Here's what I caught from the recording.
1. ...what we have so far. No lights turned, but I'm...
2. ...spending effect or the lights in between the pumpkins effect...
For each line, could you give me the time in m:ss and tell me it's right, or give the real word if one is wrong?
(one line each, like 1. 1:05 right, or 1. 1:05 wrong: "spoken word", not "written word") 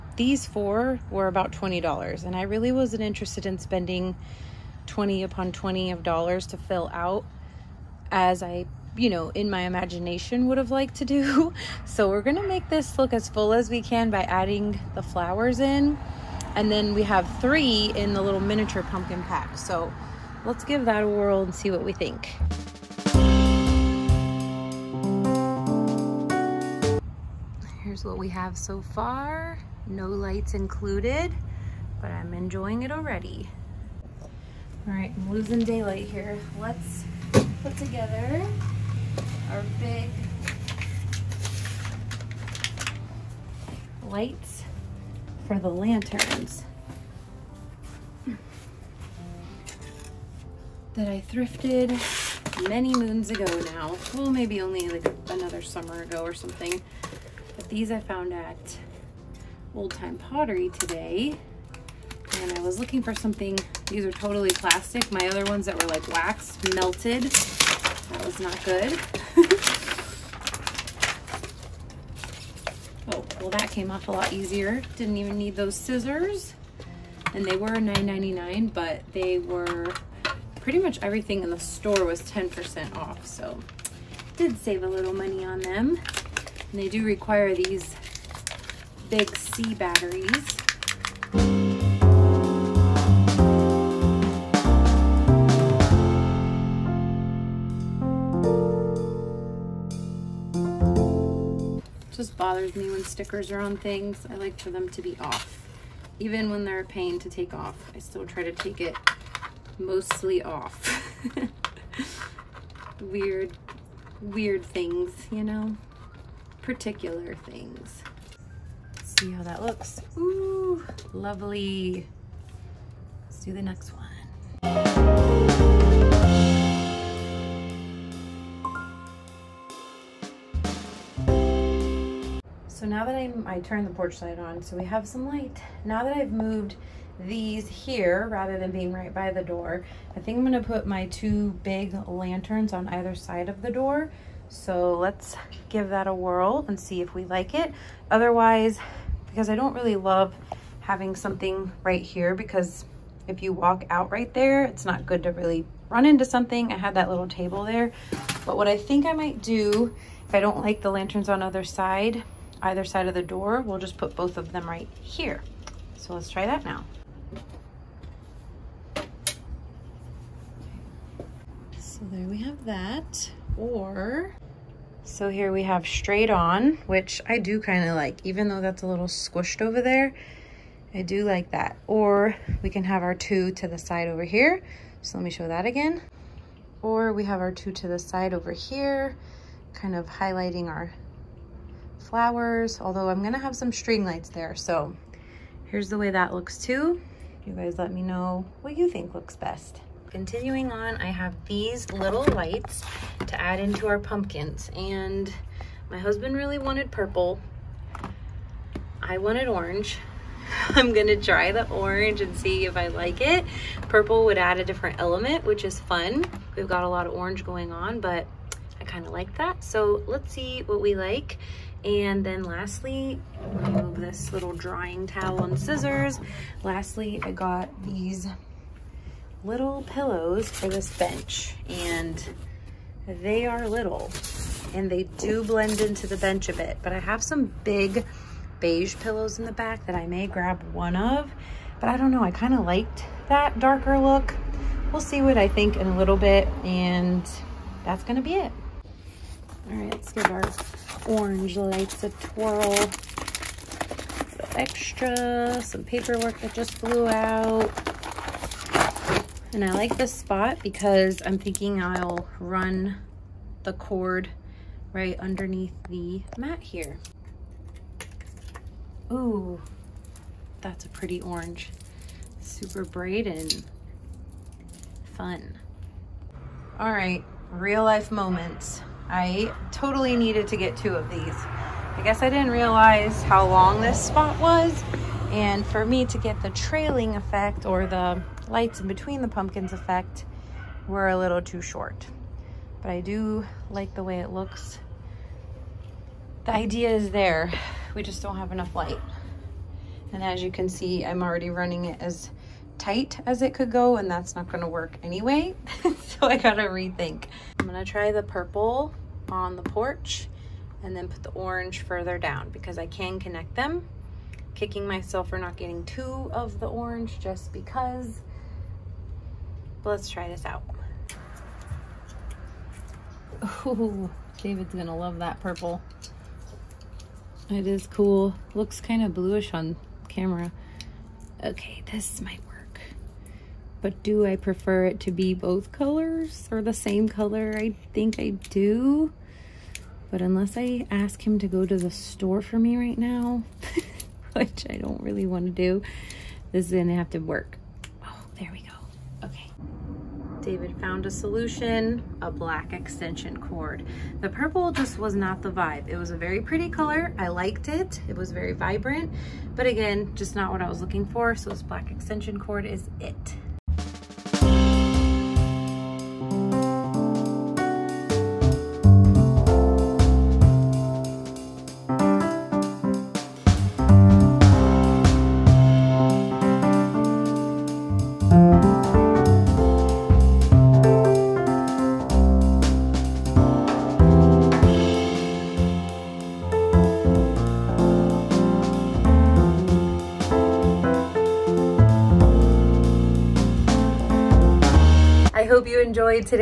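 1. 0:28 wrong: "included", not "turned"
2. 4:46 wrong: "trailing", not "spending".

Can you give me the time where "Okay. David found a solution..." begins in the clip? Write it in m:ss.
5:49.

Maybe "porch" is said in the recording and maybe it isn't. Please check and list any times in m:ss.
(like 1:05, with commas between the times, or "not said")
2:13, 5:09.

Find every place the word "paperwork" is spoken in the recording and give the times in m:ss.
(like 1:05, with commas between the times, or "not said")
4:15.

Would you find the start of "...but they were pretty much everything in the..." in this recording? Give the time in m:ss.
1:18.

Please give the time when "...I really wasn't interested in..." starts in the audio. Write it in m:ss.
0:02.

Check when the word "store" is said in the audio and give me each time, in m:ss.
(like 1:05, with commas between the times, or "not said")
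1:21, 5:41.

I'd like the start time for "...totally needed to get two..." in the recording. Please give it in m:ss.
4:39.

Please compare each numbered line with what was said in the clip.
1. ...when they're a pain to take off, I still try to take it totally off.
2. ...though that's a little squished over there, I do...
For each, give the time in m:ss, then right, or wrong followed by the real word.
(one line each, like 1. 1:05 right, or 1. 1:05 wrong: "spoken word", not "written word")
1. 1:46 wrong: "mostly", not "totally"
2. 2:58 right.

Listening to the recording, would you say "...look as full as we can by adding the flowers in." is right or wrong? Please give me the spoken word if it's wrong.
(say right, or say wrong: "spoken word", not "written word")
right.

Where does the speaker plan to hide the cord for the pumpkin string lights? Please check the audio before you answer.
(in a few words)
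Underneath the mat.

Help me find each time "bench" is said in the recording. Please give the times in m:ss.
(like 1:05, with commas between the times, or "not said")
3:50, 3:56.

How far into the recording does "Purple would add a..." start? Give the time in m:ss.
3:33.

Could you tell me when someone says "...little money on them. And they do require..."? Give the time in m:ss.
1:24.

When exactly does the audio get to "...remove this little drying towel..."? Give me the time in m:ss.
3:43.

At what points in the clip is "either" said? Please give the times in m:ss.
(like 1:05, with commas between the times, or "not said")
2:22, 2:42.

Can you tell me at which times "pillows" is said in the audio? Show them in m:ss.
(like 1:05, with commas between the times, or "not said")
3:49, 3:58.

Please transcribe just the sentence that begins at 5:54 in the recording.
The purple just was not the vibe.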